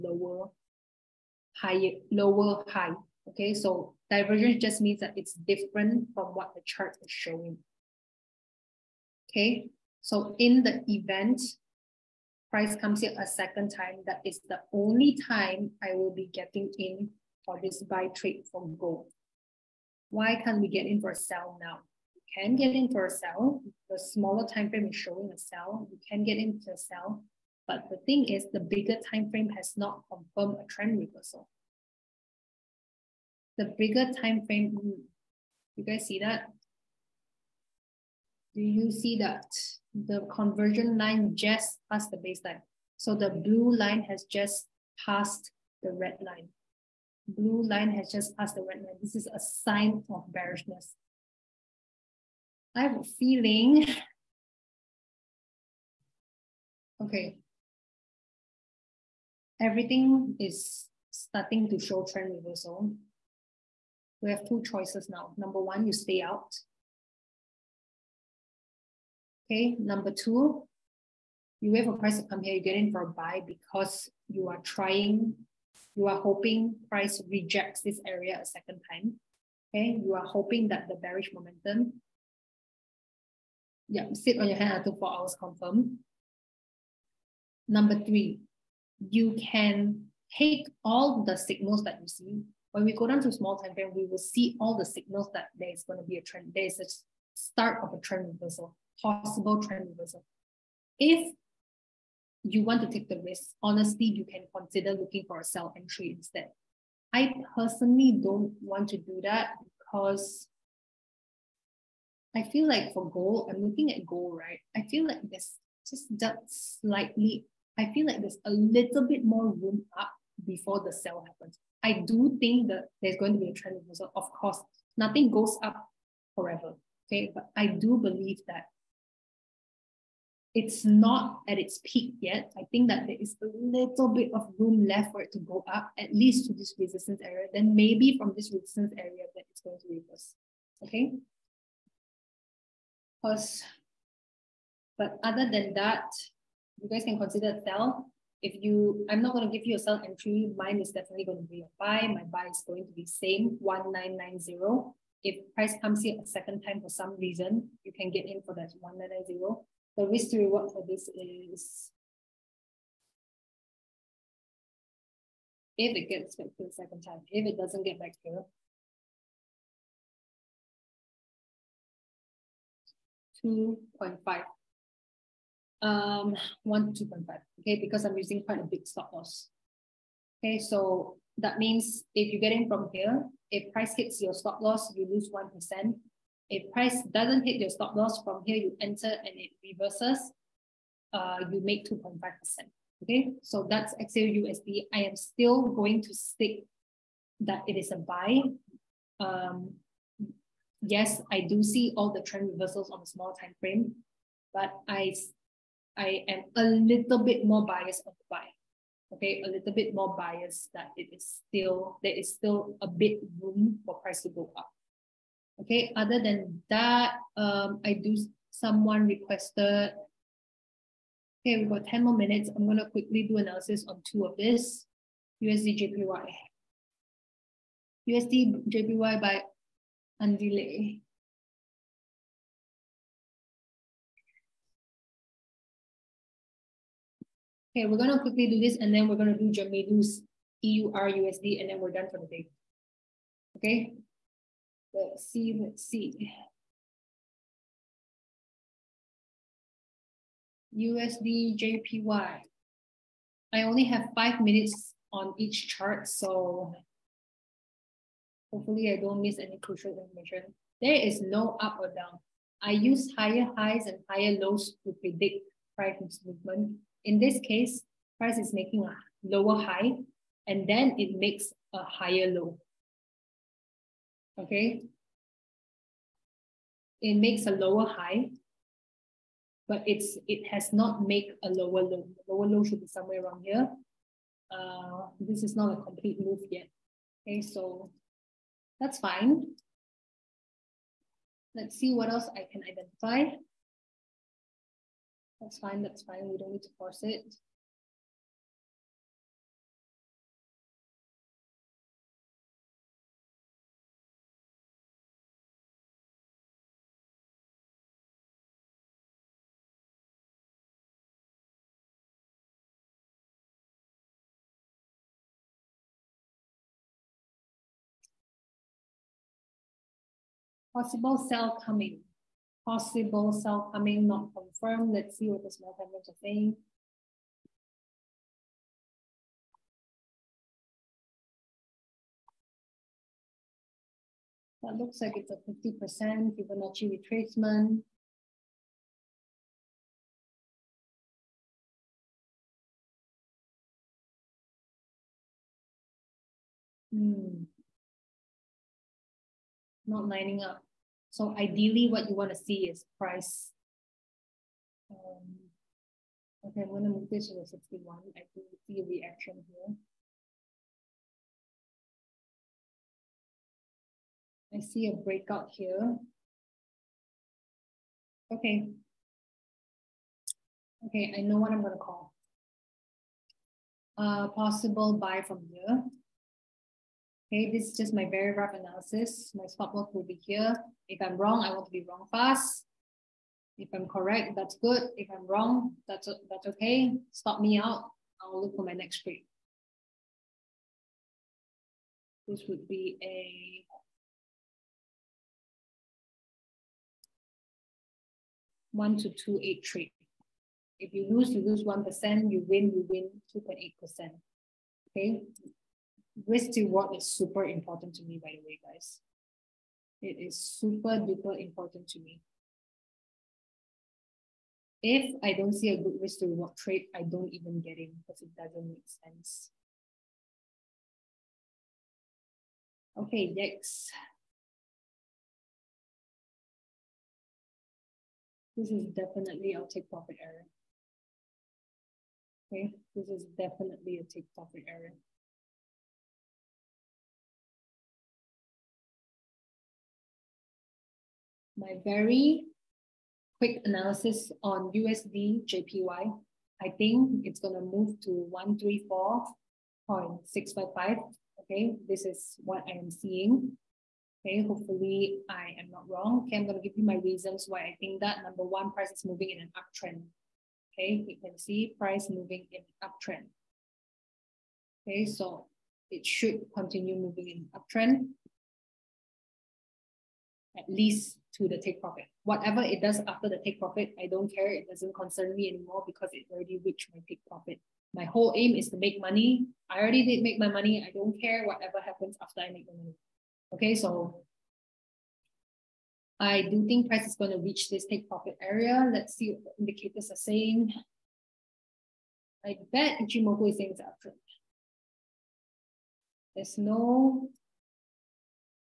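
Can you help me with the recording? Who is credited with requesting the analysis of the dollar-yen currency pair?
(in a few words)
Andile.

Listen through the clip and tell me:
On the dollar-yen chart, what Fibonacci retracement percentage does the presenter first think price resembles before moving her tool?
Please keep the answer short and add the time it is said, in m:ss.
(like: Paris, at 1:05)
50%, at 5:35.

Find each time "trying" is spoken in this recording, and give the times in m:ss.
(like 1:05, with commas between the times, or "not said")
1:14.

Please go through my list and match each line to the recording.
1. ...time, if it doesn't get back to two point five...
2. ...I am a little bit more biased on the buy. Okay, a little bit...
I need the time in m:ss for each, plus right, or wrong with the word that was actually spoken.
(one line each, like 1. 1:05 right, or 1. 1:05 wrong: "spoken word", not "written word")
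1. 2:47 right
2. 3:25 right.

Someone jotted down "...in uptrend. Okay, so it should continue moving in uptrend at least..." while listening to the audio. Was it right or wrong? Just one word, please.
right.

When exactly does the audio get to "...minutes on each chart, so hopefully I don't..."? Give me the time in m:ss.
4:14.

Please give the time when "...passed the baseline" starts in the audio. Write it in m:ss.
0:41.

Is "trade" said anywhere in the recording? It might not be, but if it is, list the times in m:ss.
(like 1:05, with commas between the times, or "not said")
0:18, 6:29, 6:39, 6:56.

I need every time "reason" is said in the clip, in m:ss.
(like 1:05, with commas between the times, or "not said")
2:37, 7:36.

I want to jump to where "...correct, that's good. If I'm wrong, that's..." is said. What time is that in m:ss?
6:23.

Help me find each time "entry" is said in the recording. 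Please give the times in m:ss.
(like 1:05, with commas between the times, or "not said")
1:45, 2:30.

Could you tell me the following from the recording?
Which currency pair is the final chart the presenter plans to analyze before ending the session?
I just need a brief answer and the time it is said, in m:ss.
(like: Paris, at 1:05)
EUR USD, at 4:00.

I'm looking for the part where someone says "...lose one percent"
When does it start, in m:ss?
3:05.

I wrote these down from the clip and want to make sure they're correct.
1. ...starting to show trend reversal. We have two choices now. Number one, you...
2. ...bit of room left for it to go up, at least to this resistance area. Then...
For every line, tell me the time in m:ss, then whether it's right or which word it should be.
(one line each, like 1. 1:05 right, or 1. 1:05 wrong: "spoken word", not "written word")
1. 1:01 right
2. 2:14 right.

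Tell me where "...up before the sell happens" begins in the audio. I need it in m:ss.
1:59.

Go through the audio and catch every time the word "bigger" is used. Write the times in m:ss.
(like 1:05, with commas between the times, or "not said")
0:28, 0:33.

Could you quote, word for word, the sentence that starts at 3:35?
Okay, other than that, um, I do, someone requested, okay, we've got 10 more minutes.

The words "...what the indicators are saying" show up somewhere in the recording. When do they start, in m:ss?
8:09.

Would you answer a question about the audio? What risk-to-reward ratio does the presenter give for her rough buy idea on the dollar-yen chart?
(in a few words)
1 to 2.8.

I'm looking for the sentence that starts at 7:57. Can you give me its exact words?
My whole aim is to make money.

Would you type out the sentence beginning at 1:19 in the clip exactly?
Okay, you are hoping that the bearish momentum.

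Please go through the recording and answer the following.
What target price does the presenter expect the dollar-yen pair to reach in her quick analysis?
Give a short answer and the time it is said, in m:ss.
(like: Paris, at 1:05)
134.655, at 7:29.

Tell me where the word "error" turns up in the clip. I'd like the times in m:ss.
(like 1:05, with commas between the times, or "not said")
7:10, 7:14.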